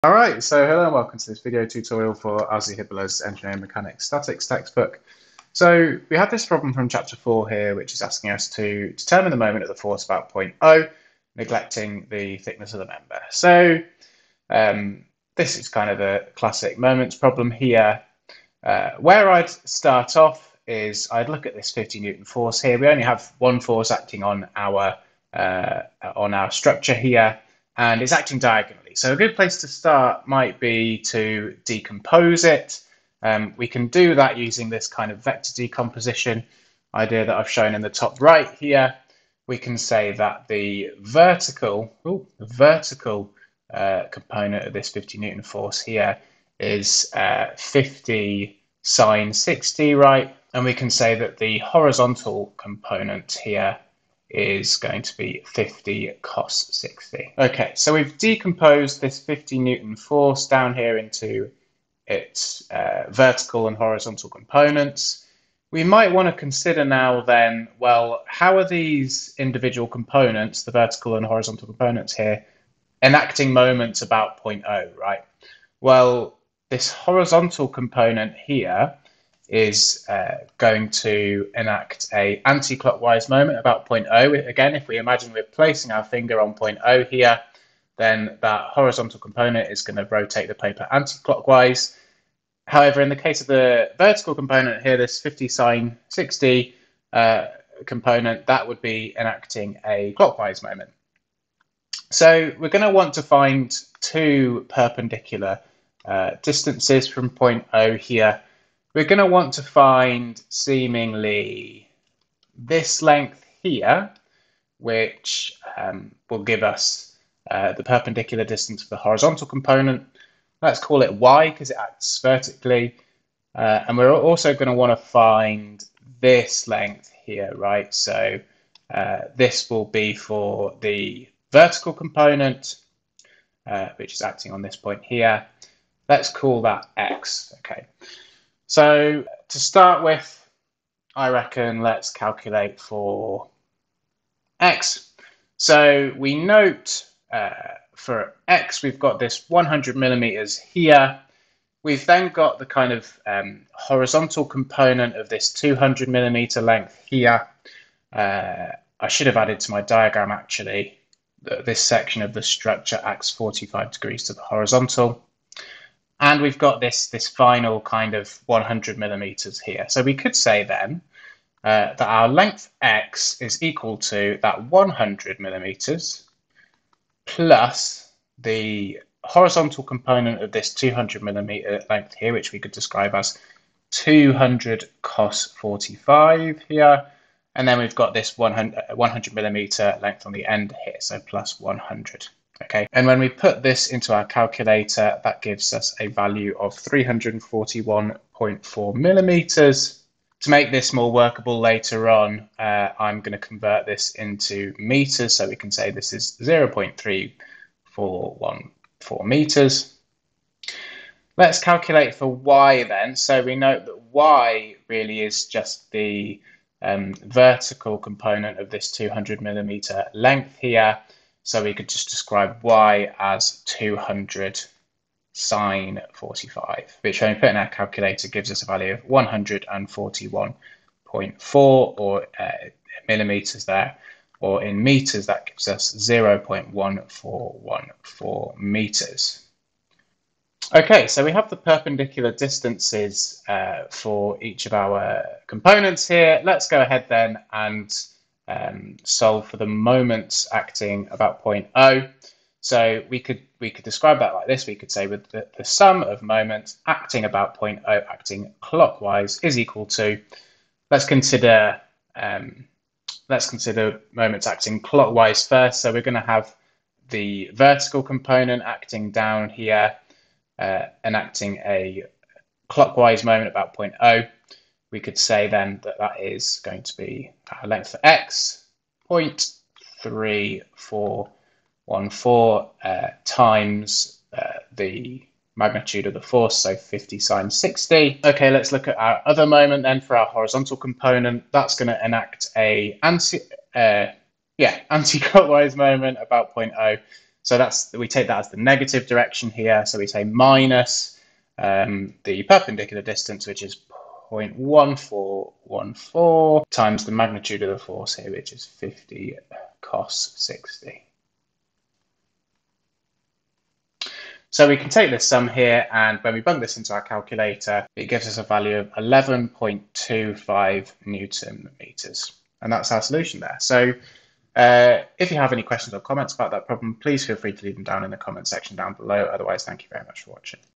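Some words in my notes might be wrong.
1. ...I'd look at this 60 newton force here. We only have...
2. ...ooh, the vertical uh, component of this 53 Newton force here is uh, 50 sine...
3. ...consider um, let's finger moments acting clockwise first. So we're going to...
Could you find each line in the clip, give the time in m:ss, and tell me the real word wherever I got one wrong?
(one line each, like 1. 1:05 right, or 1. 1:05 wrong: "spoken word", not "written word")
1. 0:21 wrong: "50", not "60"
2. 0:42 wrong: "50", not "53"
3. 4:21 wrong: "consider", not "finger".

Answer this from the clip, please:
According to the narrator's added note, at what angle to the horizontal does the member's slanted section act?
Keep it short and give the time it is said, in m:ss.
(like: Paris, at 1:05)
45 degrees, at 2:43.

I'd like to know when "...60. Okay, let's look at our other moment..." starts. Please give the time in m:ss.
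4:47.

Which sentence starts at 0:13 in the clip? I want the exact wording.
So um, this is kind of a classic moments problem here.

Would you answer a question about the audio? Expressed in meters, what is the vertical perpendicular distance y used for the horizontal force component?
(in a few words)
0.1414 meters.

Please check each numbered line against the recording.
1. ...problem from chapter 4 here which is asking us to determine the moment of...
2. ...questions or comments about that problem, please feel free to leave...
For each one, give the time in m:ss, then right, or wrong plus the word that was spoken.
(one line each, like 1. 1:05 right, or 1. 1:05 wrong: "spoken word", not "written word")
1. 0:06 right
2. 5:25 right.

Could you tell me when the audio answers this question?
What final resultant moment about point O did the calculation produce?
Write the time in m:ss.
5:18.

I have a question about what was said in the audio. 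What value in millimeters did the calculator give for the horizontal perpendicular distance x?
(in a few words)
341.4 millimeters.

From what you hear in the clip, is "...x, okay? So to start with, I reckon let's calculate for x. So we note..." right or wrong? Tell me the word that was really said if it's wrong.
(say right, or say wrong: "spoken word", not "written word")
right.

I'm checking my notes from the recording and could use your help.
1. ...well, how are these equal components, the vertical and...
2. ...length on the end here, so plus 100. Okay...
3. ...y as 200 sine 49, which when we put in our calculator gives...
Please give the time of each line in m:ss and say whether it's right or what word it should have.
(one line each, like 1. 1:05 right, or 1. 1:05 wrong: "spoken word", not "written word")
1. 1:07 wrong: "individual", not "equal"
2. 3:10 right
3. 3:42 wrong: "45", not "49".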